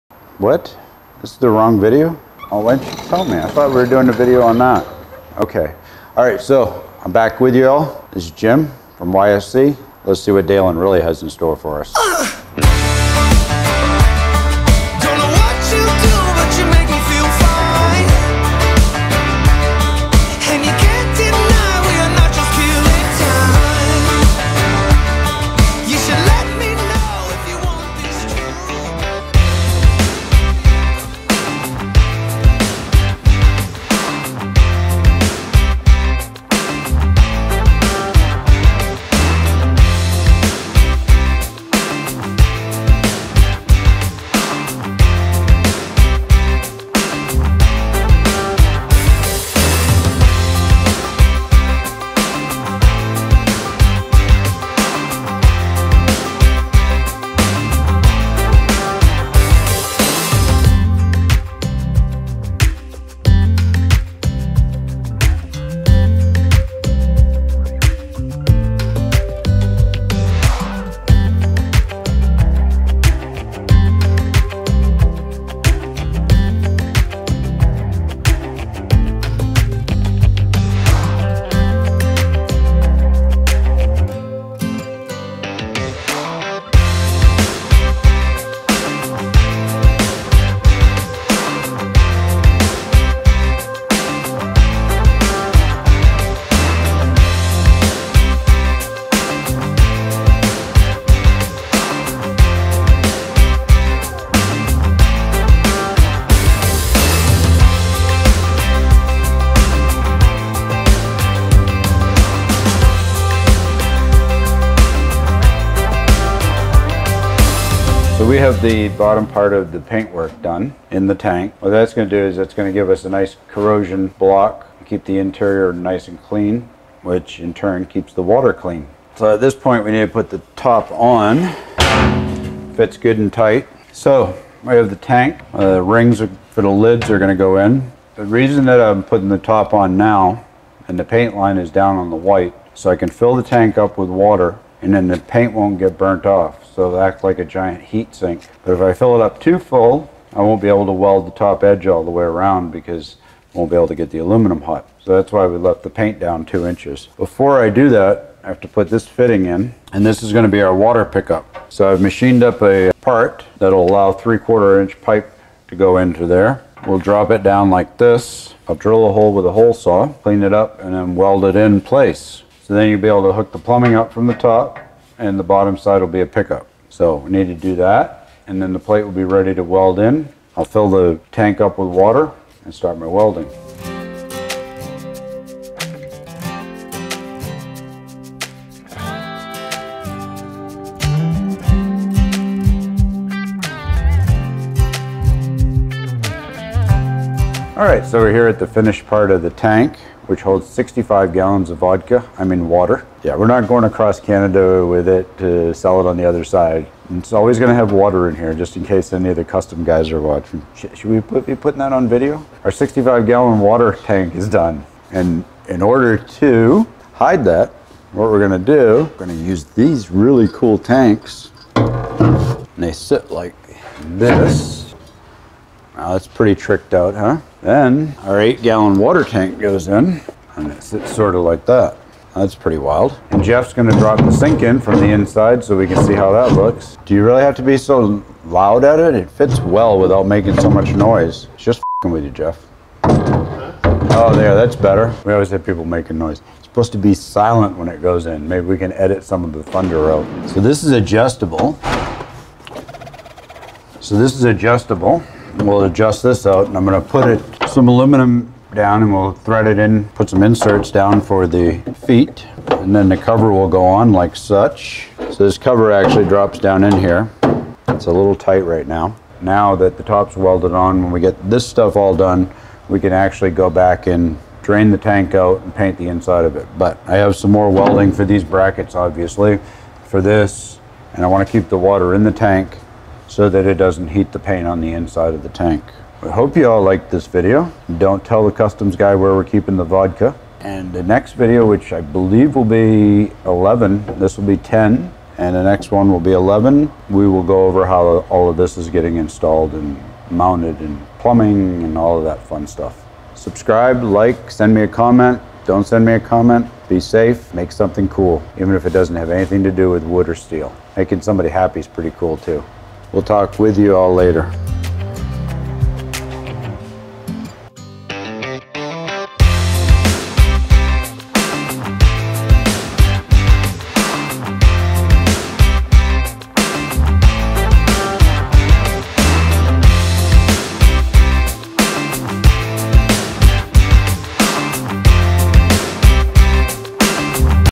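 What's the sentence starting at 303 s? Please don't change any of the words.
Subscribe, like, send me a comment.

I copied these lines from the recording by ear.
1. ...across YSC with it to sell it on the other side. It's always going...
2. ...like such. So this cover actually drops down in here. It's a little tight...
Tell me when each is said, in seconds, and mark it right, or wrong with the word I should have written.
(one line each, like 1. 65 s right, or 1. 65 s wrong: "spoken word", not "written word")
1. 203 s wrong: "Canada", not "YSC"
2. 264 s right.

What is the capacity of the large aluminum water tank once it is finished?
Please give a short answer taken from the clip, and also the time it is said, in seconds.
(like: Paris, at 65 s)
65 gallons, at 200 s.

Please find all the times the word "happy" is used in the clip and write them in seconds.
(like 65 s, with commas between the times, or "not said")
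311 s.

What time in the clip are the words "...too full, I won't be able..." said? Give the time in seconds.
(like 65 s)
149 s.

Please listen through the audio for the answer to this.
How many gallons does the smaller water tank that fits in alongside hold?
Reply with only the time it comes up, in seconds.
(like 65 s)
228 s.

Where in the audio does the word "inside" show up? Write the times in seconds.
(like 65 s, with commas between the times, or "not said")
235 s, 276 s, 284 s.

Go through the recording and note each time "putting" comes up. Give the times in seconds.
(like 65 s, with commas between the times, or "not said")
139 s, 211 s.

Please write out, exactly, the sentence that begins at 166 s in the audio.
We'll drop it down like this.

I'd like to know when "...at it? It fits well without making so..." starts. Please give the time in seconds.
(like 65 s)
238 s.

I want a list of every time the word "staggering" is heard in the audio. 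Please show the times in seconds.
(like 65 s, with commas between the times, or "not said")
not said.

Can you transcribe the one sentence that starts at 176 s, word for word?
So we need to do that and then the plate will be ready to weld in.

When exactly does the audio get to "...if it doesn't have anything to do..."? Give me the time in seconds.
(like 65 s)
308 s.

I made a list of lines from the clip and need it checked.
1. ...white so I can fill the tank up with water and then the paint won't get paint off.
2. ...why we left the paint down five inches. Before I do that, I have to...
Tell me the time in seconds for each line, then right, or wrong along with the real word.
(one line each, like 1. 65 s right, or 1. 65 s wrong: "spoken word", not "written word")
1. 142 s wrong: "burnt", not "paint"
2. 155 s wrong: "two", not "five".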